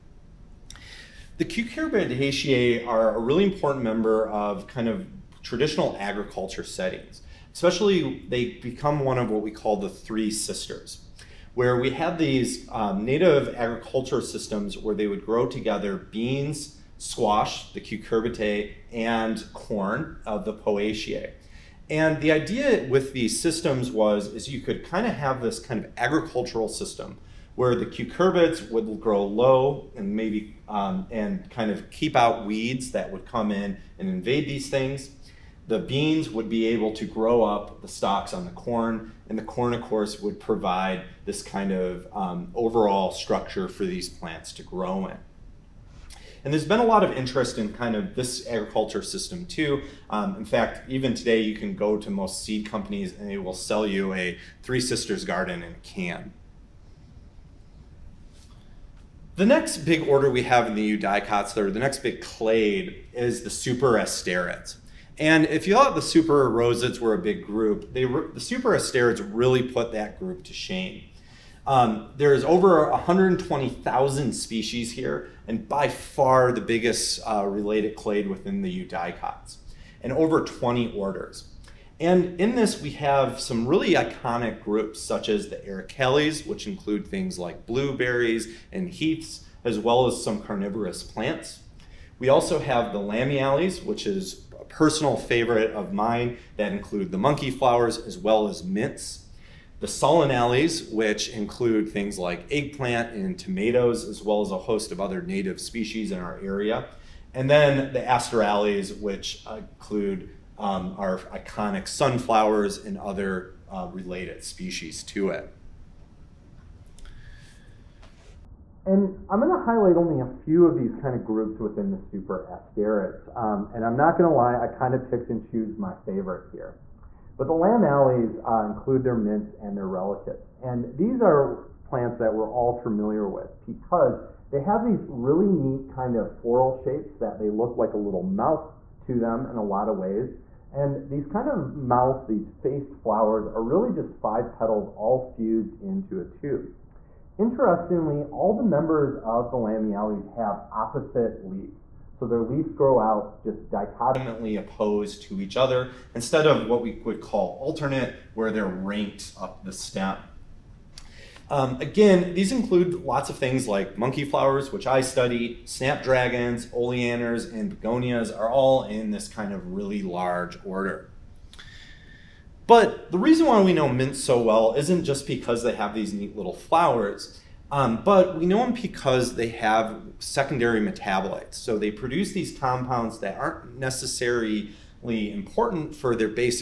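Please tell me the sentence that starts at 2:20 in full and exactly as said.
And these kind of mouths, these faced flowers, are really just five petals all fused into a tube.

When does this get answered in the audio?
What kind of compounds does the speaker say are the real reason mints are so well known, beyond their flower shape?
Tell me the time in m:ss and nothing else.
3:00.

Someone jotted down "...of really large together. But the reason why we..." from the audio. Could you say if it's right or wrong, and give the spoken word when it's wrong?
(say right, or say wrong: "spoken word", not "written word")
wrong: "order", not "together".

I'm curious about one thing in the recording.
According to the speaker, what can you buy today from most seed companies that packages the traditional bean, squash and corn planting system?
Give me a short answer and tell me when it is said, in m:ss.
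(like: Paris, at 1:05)
Three Sisters garden in a can, at 0:54.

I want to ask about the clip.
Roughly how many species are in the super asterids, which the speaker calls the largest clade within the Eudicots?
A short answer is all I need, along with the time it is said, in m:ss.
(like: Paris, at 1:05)
over 120,000, at 1:12.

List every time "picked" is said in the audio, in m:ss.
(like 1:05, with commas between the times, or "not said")
2:05.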